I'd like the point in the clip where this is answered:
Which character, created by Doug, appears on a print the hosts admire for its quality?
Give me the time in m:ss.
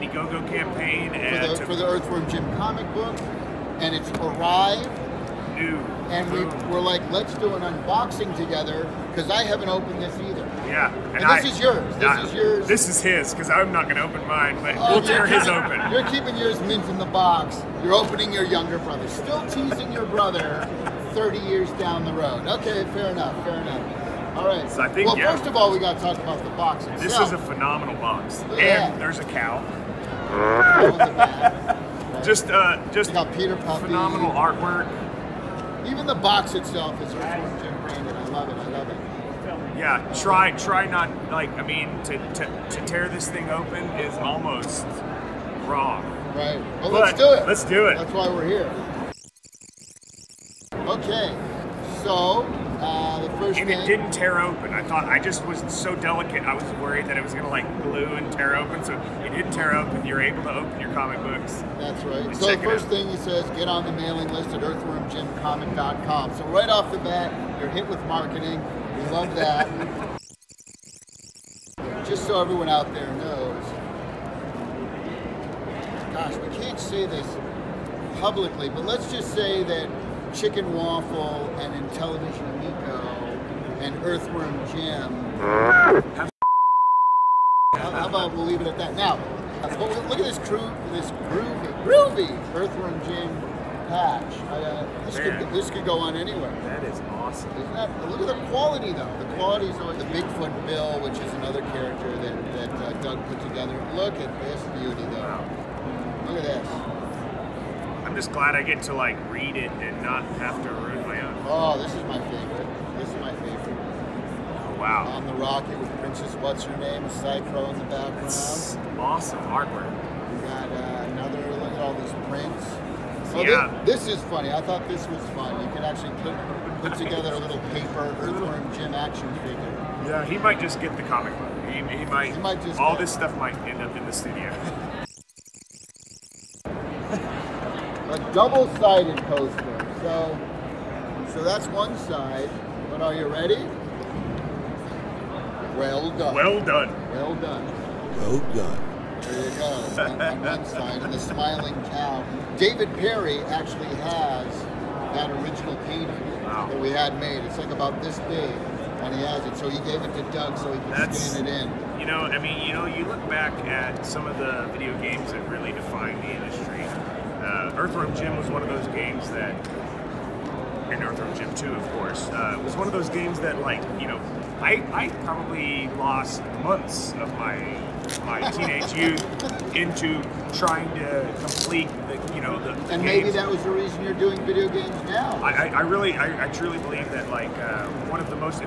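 1:40.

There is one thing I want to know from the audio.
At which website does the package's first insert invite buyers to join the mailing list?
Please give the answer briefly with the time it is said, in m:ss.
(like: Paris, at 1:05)
earthwormjimcomic.com, at 1:04.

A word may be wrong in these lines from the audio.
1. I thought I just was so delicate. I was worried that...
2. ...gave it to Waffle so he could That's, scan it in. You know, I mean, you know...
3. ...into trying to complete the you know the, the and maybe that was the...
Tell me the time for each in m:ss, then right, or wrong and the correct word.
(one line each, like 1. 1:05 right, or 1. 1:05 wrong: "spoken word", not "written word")
1. 0:54 right
2. 2:39 wrong: "Doug", not "Waffle"
3. 2:59 right.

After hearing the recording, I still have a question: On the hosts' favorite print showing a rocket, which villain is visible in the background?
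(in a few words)
Psy-Crow.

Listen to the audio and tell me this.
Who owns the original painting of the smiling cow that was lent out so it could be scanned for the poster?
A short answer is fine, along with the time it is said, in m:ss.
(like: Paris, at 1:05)
David Perry, at 2:32.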